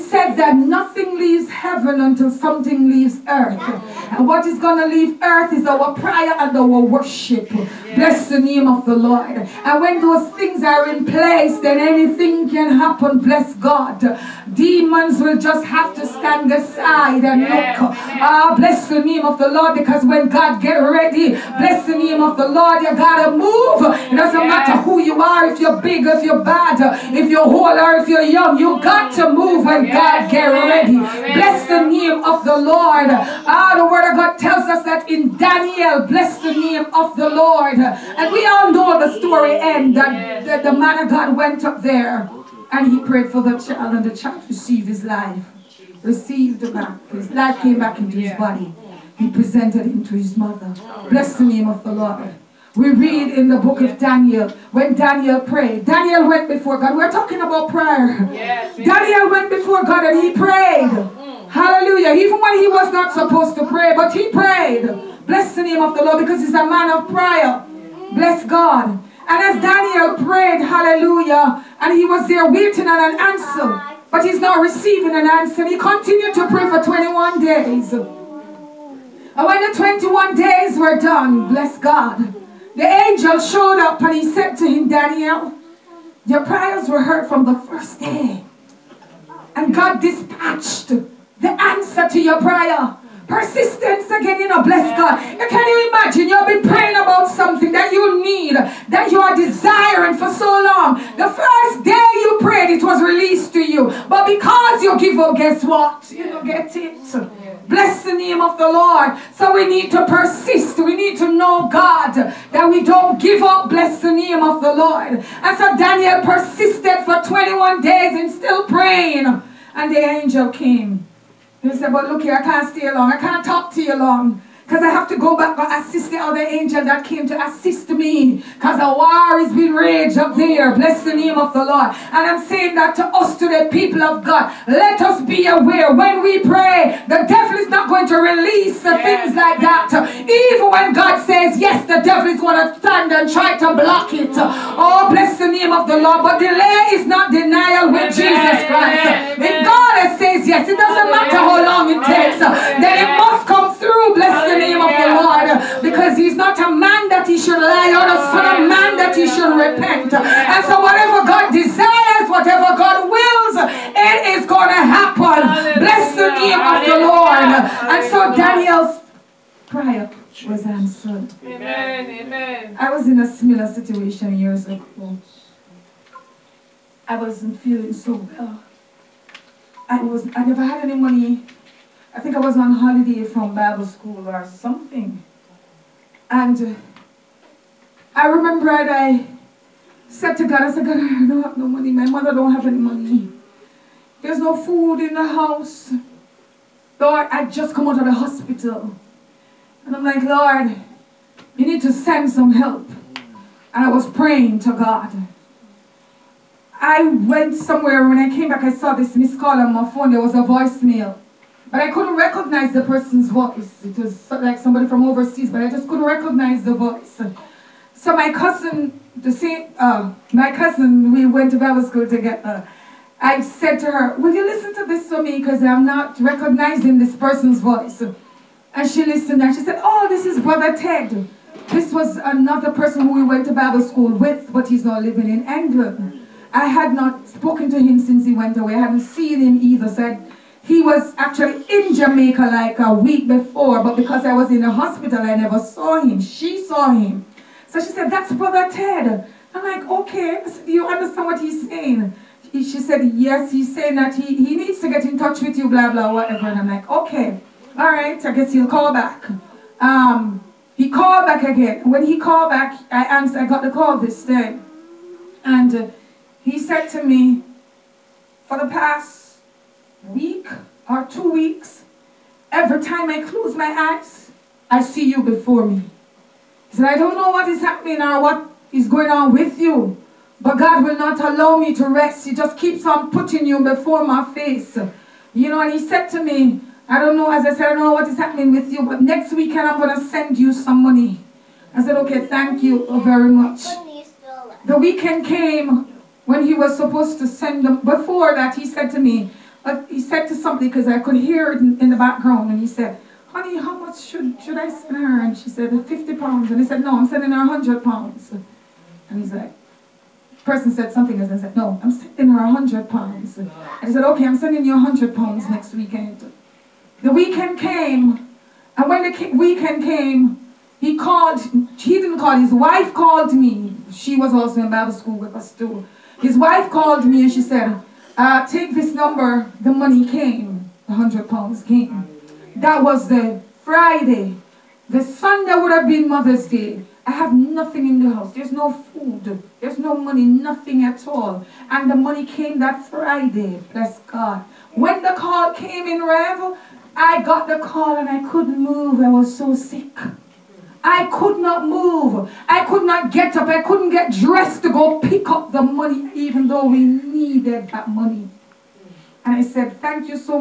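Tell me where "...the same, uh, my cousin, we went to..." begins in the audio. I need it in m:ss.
3:39.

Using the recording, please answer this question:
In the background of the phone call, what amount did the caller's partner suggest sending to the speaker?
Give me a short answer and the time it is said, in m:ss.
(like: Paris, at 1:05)
50 pounds, at 5:05.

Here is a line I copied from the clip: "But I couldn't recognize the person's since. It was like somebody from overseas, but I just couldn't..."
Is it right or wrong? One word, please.
wrong.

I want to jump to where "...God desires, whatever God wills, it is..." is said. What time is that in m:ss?
2:41.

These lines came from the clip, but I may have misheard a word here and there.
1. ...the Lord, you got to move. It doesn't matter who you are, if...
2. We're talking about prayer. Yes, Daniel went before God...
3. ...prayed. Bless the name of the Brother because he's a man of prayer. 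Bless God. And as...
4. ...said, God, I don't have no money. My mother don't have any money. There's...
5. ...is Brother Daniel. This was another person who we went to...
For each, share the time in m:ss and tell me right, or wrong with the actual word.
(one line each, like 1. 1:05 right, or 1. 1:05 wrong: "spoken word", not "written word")
1. 0:22 right
2. 0:56 right
3. 1:04 wrong: "Lord", not "Brother"
4. 3:10 right
5. 3:50 wrong: "Ted", not "Daniel".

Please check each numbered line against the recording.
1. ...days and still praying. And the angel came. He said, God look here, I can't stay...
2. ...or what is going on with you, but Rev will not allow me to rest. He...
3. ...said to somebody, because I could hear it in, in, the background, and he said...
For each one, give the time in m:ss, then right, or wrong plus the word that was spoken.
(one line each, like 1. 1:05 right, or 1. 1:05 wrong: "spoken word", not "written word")
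1. 1:57 wrong: "But", not "God"
2. 4:38 wrong: "God", not "Rev"
3. 4:59 right.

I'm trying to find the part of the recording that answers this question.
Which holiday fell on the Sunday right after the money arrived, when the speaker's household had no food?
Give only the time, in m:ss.
5:36.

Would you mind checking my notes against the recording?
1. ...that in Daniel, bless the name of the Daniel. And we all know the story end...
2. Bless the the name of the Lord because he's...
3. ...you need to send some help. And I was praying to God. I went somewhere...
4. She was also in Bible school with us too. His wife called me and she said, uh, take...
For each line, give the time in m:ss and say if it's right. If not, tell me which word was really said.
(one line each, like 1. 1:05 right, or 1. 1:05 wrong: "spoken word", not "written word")
1. 0:34 wrong: "Lord", not "Daniel"
2. 2:34 right
3. 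3:21 right
4. 5:23 right.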